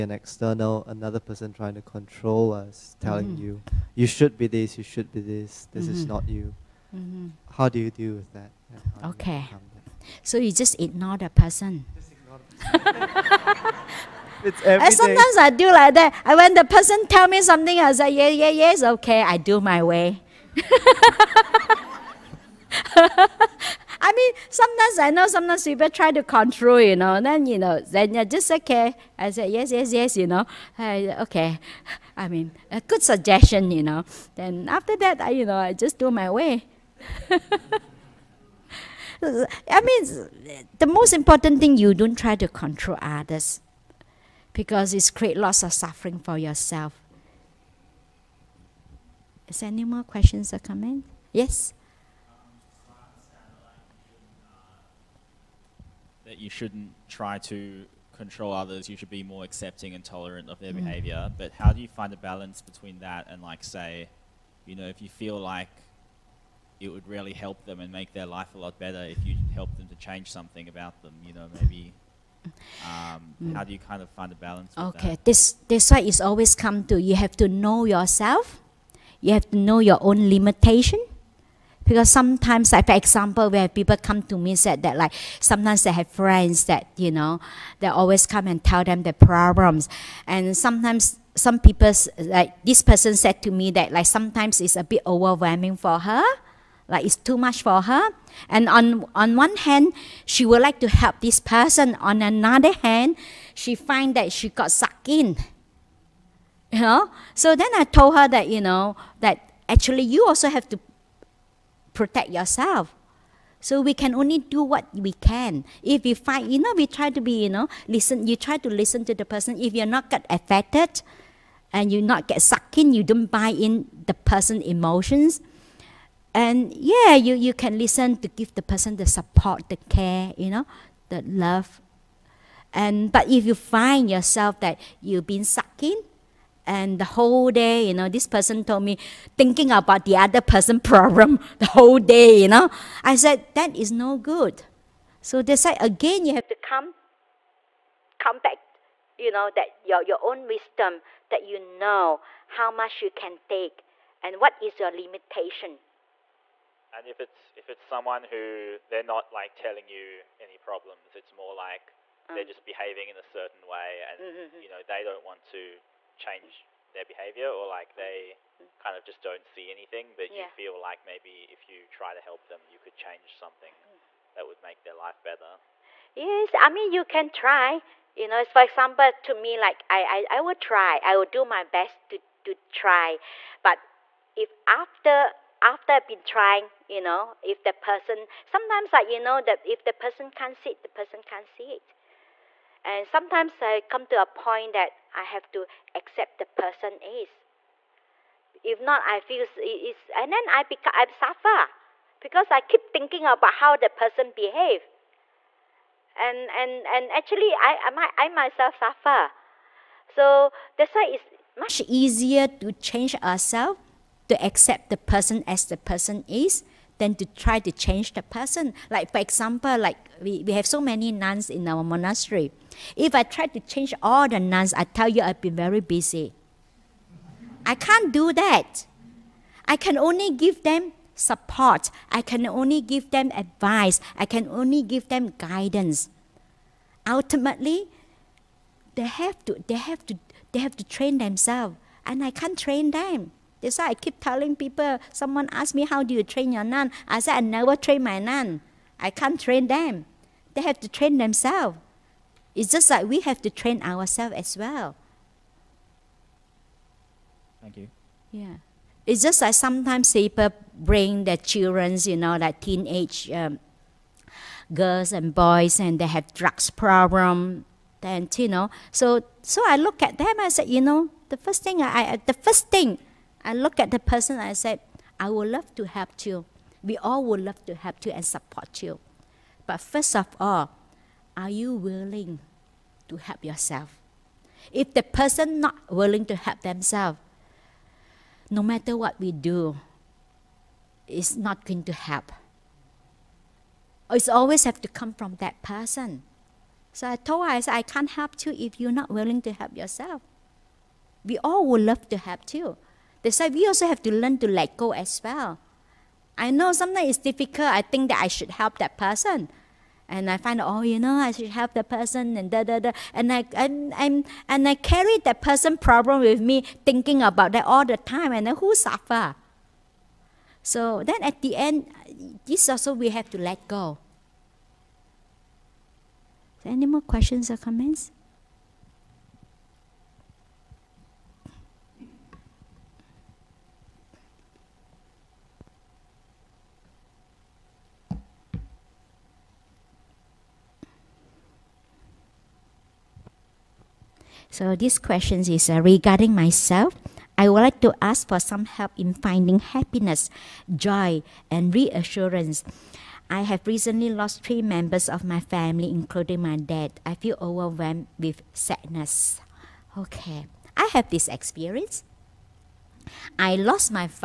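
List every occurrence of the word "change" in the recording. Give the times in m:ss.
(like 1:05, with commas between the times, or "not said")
1:09, 2:46, 2:52, 3:32, 3:37, 3:43.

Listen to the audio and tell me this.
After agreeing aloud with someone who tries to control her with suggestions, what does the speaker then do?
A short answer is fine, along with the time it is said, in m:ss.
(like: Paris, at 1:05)
I do my way, at 0:19.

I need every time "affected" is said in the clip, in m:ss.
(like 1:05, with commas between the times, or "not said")
2:00.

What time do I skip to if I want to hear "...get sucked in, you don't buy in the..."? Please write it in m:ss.
2:02.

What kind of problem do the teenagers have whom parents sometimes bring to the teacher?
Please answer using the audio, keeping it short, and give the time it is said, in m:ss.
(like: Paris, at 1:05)
drugs problem, at 4:26.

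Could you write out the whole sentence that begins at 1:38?
And on, on one hand, she would like to help this person.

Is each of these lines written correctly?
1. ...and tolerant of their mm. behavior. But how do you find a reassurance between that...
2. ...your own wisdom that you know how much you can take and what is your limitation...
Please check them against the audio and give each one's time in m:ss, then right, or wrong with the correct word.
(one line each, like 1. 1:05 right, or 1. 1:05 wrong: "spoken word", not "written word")
1. 0:59 wrong: "balance", not "reassurance"
2. 2:30 right.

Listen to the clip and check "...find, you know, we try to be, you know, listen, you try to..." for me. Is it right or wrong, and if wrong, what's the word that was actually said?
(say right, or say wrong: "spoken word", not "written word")
right.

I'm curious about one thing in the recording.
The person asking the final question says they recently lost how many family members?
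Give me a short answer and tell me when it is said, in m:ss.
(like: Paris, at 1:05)
3, at 5:54.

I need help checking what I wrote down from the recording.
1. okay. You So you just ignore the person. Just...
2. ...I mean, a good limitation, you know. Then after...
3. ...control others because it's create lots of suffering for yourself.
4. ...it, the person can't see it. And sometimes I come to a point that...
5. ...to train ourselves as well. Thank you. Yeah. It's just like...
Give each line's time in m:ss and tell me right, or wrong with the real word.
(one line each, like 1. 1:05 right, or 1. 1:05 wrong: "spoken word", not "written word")
1. 0:09 right
2. 0:32 wrong: "suggestion", not "limitation"
3. 0:42 right
4. 3:10 right
5. 4:13 right.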